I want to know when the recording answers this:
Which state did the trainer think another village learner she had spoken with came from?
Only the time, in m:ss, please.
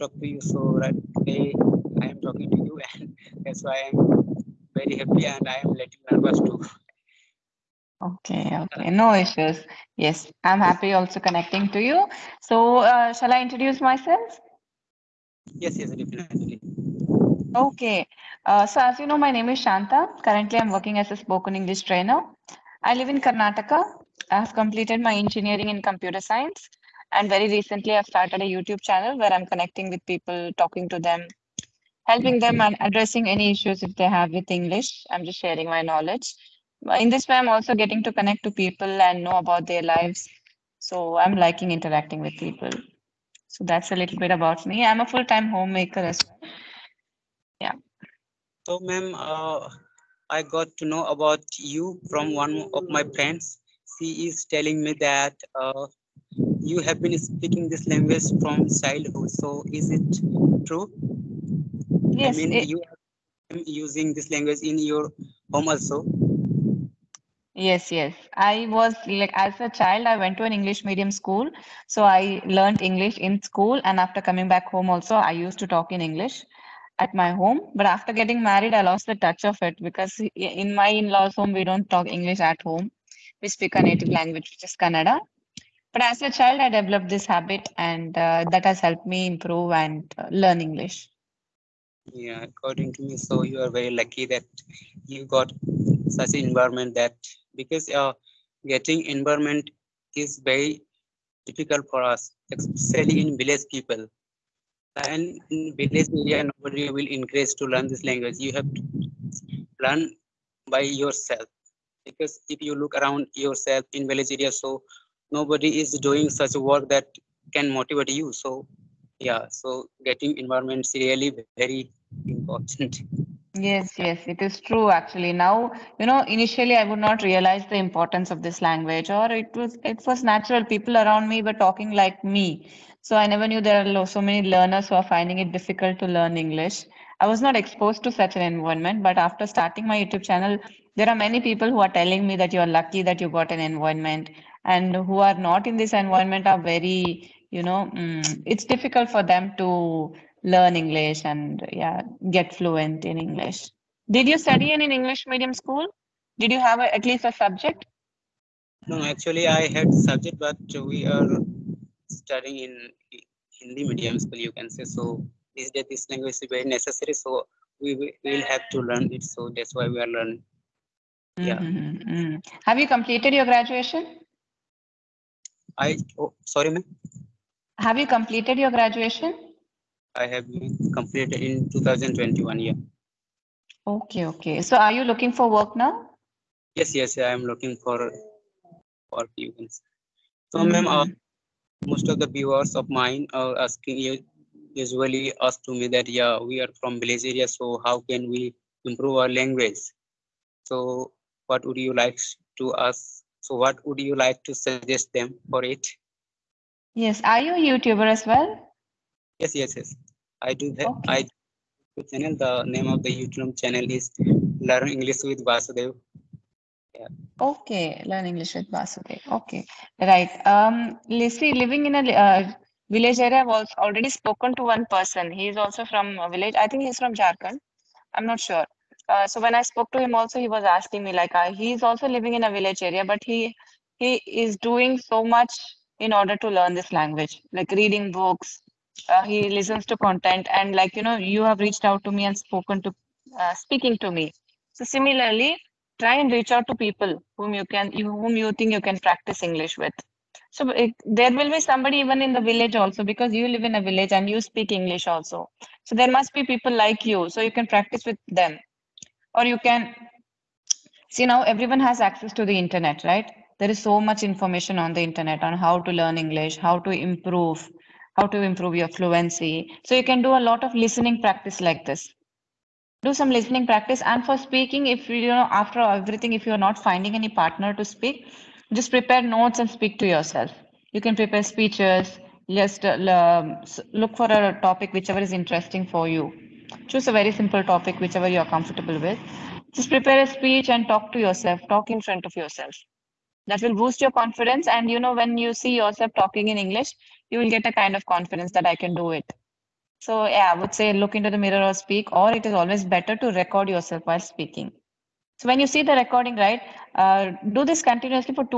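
3:47.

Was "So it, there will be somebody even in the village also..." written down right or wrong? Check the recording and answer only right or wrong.
right.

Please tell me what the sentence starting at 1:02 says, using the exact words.
I mean, it, you are using this language in your home also.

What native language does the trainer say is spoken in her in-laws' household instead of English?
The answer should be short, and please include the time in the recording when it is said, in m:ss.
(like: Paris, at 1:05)
Kannada, at 1:24.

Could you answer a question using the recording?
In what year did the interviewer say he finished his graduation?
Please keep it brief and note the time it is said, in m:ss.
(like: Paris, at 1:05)
2021, at 3:01.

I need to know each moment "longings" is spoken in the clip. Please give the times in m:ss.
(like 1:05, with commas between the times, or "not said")
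not said.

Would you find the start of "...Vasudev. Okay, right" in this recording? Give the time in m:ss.
3:38.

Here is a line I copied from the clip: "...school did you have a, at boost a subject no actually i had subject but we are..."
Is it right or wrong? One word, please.
wrong.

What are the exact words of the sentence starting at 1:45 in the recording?
And in village area, nobody will encourage to learn this language.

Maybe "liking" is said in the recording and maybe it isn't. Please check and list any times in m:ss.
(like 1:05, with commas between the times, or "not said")
0:41.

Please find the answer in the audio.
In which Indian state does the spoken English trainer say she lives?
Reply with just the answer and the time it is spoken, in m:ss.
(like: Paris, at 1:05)
Karnataka, at 0:23.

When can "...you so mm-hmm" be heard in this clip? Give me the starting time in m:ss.
3:09.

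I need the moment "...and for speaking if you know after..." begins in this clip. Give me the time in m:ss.
4:34.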